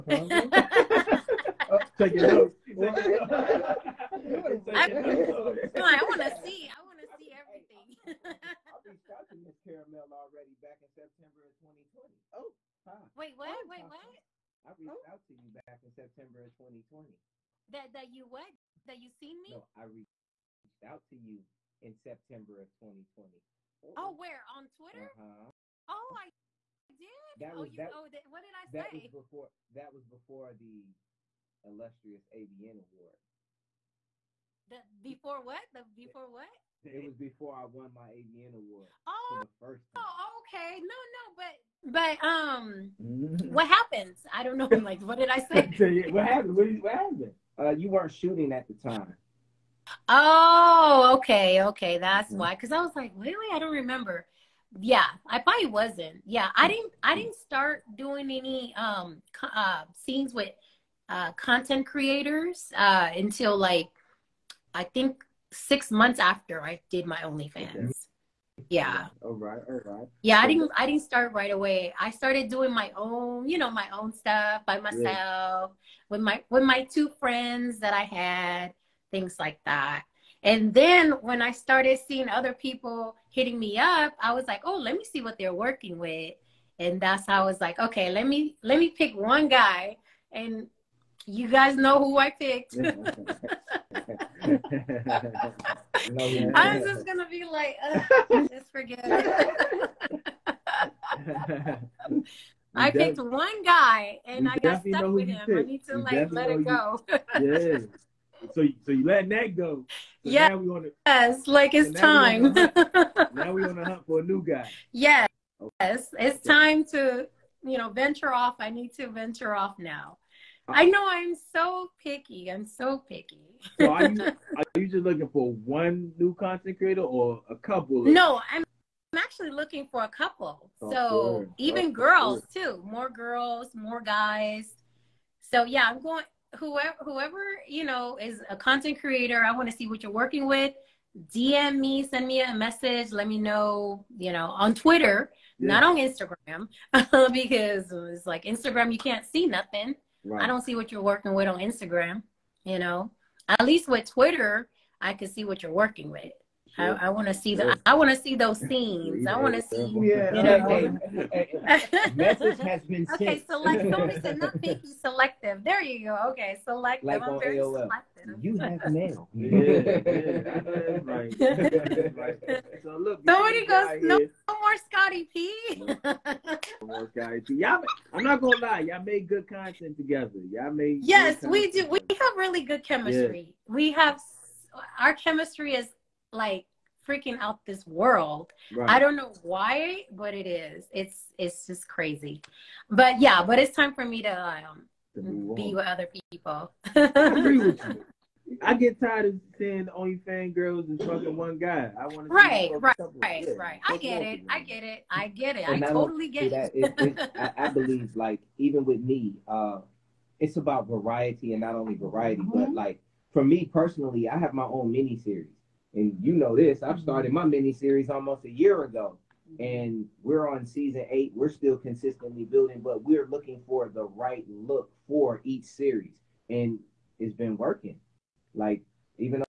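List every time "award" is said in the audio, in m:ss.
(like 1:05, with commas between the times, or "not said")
0:32, 0:38.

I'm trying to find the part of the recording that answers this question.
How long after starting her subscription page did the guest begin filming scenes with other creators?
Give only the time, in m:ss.
1:05.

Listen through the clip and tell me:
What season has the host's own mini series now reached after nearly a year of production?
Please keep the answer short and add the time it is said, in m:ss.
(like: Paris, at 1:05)
Season 8, at 3:40.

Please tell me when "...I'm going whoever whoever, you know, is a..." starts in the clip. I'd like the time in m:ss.
2:15.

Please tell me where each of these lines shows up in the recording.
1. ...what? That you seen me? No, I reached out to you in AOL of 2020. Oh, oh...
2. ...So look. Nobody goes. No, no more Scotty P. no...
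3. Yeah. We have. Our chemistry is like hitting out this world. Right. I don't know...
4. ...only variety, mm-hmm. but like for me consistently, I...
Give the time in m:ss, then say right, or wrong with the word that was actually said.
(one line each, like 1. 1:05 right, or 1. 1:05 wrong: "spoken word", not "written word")
1. 0:18 wrong: "September", not "AOL"
2. 2:52 right
3. 3:03 wrong: "freaking", not "hitting"
4. 3:31 wrong: "personally", not "consistently".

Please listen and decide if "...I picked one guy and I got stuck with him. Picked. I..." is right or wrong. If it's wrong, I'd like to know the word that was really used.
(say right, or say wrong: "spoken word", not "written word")
right.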